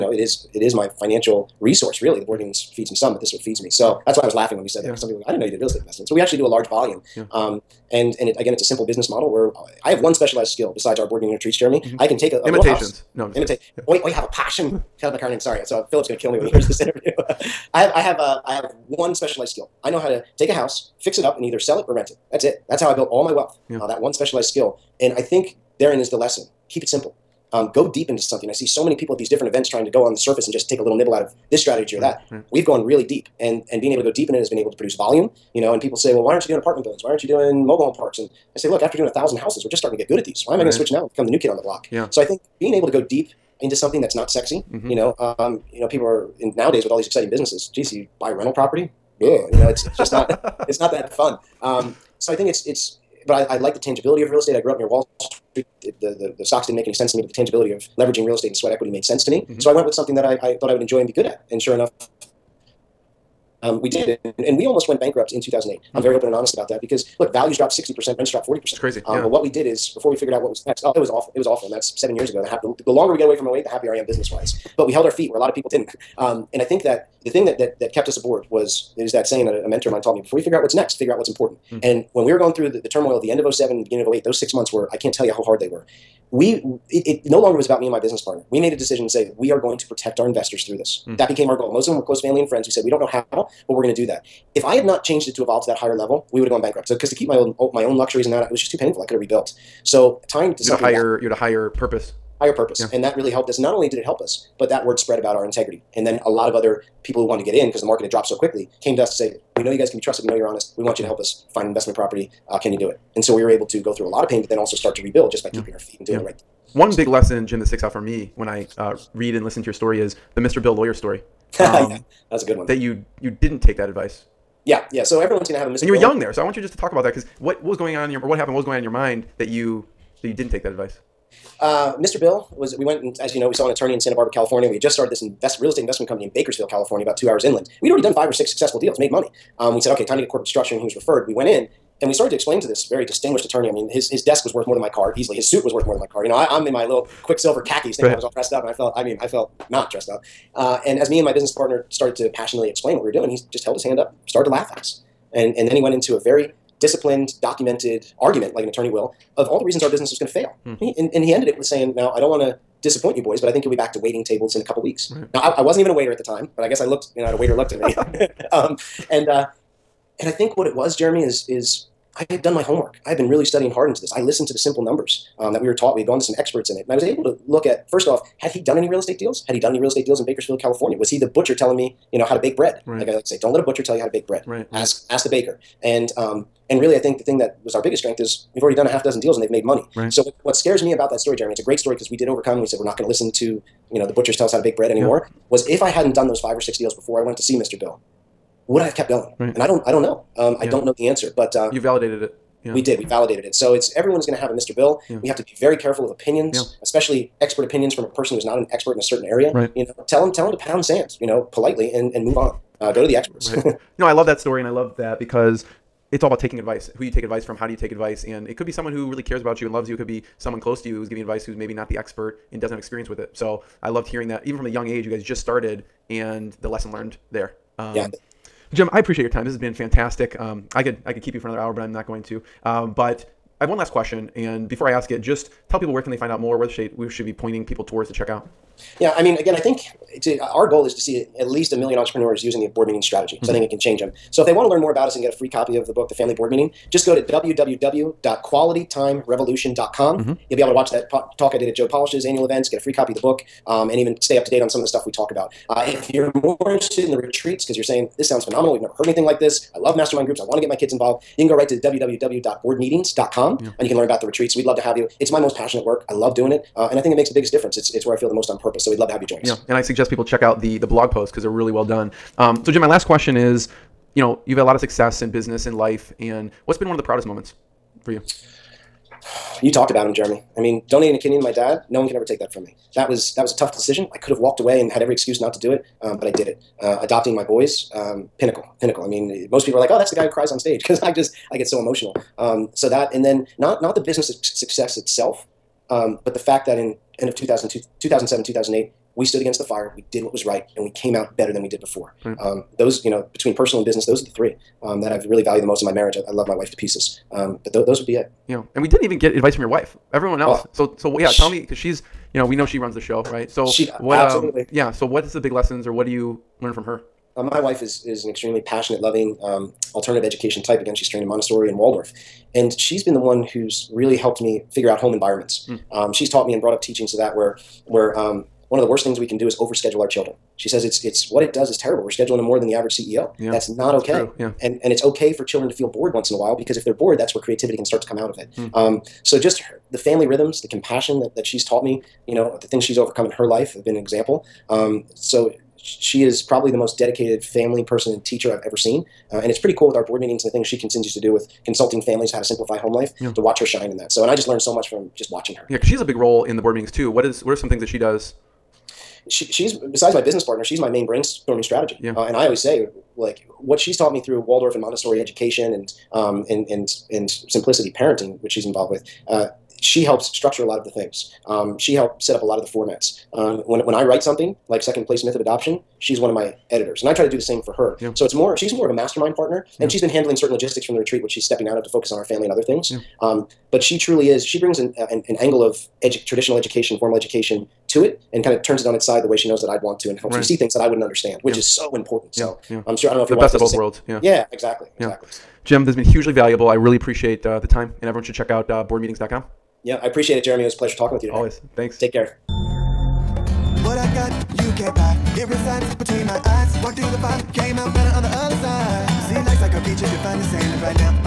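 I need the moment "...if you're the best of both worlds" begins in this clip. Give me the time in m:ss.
6:33.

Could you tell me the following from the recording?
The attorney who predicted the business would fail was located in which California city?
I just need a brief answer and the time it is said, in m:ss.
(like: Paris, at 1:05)
Santa Barbara, at 2:13.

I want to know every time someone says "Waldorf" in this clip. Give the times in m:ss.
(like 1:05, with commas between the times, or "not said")
5:21, 6:04.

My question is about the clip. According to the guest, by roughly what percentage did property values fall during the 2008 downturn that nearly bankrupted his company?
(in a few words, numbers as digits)
60%.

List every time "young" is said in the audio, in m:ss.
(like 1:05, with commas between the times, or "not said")
2:06, 3:44.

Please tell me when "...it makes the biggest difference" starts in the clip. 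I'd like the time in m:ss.
4:27.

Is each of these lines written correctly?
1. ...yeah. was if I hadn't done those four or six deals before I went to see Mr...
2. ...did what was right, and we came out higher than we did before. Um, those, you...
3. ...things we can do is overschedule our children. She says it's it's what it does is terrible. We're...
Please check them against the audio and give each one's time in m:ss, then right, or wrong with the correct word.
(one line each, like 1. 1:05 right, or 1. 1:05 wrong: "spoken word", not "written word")
1. 3:15 wrong: "five", not "four"
2. 5:00 wrong: "better", not "higher"
3. 5:29 right.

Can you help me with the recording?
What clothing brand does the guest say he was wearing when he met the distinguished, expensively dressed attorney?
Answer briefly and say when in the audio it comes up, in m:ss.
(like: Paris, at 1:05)
Quiksilver, at 2:27.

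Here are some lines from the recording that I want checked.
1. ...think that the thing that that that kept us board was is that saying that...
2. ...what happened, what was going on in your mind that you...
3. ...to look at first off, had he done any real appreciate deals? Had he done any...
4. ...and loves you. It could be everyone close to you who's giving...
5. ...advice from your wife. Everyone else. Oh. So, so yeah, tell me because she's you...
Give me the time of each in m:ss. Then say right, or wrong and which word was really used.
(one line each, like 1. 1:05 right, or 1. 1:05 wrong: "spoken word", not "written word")
1. 1:16 wrong: "aboard", not "board"
2. 2:08 right
3. 2:57 wrong: "estate", not "appreciate"
4. 3:39 wrong: "someone", not "everyone"
5. 5:09 right.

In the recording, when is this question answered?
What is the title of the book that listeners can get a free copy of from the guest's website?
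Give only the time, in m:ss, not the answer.
4:06.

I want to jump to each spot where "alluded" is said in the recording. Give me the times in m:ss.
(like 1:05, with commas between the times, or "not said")
not said.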